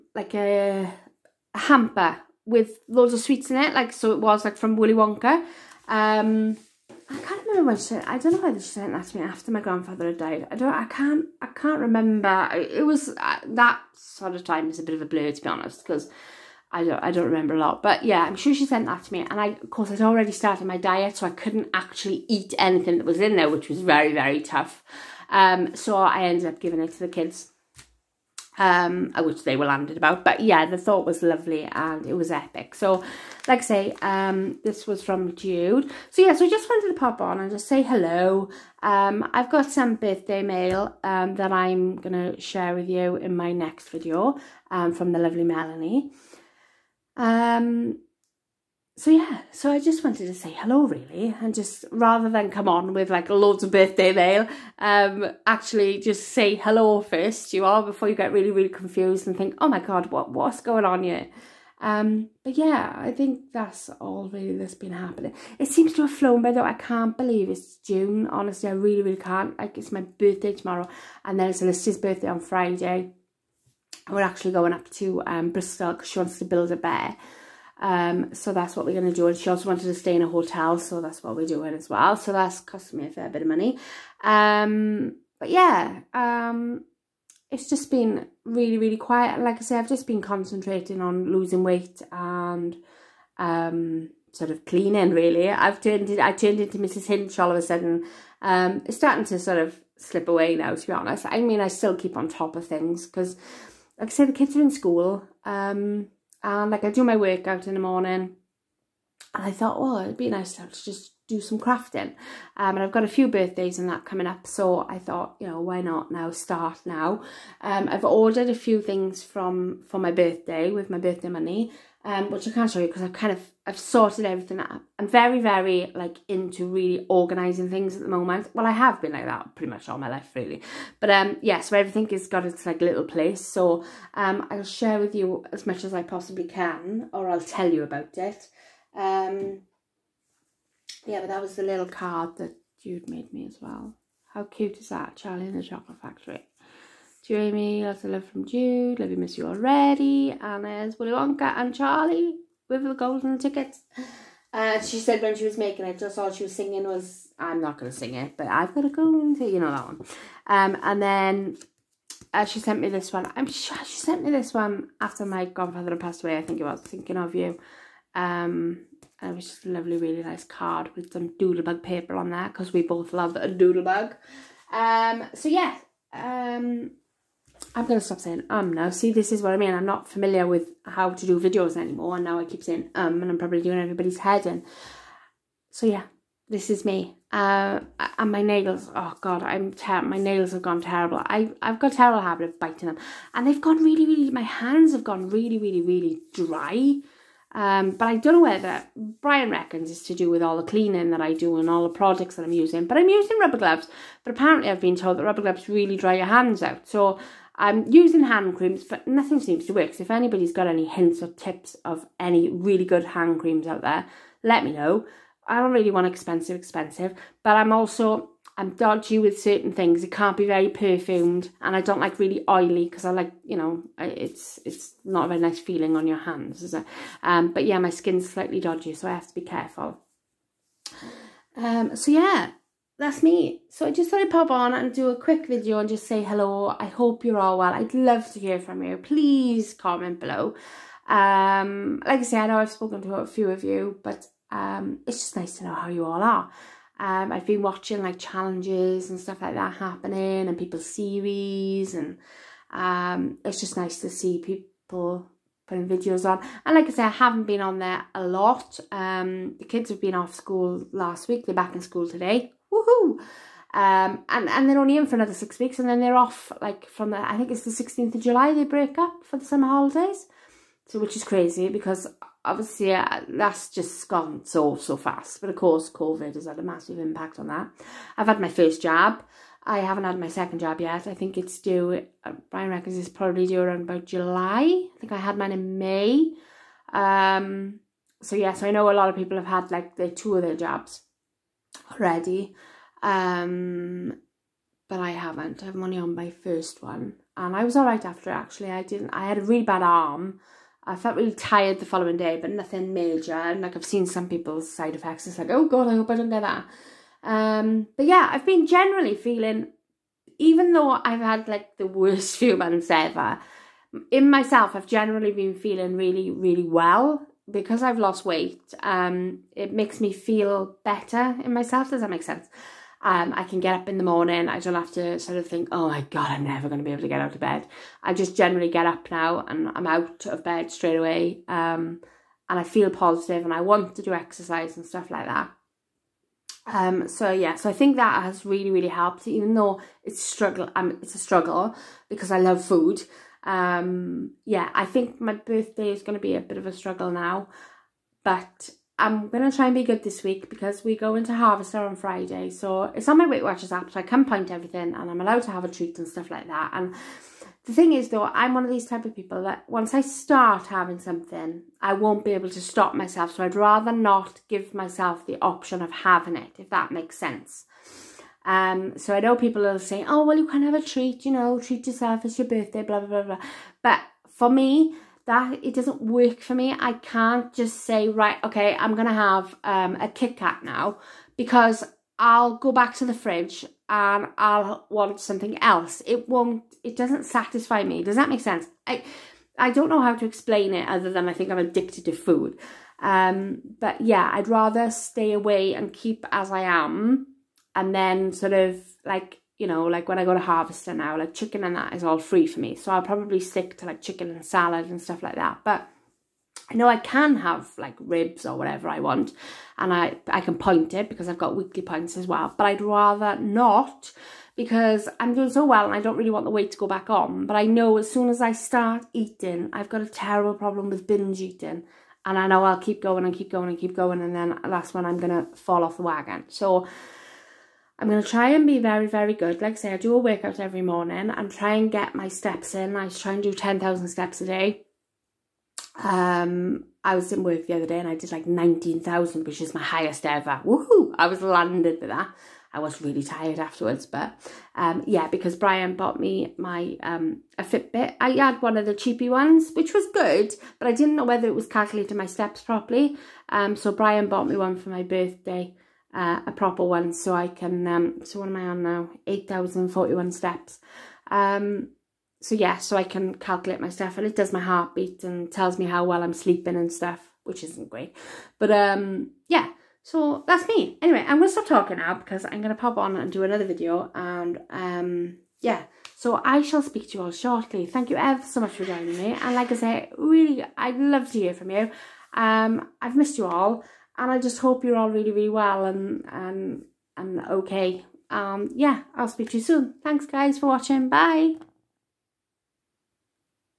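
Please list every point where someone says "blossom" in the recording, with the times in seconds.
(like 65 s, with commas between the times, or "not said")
not said.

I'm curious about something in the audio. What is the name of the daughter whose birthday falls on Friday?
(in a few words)
Alicia.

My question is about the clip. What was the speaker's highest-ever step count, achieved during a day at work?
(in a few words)
19,000.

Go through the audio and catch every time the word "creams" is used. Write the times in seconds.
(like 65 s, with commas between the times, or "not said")
208 s, 213 s.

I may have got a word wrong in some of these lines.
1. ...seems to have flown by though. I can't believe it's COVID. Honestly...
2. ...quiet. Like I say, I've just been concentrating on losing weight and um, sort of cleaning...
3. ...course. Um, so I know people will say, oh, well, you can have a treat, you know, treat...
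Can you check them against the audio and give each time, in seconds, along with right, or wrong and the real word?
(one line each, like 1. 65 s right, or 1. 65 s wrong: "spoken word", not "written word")
1. 65 s wrong: "June", not "COVID"
2. 88 s right
3. 367 s wrong: "sense", not "course".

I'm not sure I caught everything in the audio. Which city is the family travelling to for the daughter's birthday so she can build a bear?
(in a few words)
Bristol.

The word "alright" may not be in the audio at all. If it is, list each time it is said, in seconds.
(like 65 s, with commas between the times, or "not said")
297 s.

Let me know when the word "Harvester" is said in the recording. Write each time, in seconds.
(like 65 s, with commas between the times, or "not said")
351 s, 400 s.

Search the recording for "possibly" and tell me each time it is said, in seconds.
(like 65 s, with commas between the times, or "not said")
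136 s.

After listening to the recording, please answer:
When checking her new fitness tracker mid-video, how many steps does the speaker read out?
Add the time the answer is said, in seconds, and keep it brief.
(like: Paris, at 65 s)
8,041, at 459 s.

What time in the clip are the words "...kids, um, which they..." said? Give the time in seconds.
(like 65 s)
27 s.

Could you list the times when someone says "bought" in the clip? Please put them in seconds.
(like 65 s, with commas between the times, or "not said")
445 s, 454 s.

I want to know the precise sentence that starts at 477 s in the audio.
Thank you ever so much for joining me.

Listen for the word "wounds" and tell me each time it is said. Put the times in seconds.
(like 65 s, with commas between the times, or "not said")
not said.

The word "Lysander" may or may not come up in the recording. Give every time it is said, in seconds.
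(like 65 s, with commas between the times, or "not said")
not said.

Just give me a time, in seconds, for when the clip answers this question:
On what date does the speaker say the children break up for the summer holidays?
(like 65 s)
267 s.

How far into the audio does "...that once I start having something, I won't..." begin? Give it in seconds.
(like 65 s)
359 s.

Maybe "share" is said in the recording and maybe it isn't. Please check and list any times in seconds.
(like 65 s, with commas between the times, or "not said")
42 s, 134 s.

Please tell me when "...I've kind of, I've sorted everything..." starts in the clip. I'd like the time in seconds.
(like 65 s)
123 s.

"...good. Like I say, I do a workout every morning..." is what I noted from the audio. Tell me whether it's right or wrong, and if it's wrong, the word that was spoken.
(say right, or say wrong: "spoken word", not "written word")
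right.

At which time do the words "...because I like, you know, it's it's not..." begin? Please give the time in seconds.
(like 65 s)
222 s.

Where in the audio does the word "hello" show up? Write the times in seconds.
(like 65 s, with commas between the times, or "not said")
37 s, 50 s, 56 s, 236 s.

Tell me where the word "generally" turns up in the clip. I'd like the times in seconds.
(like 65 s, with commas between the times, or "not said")
308 s, 314 s, 328 s.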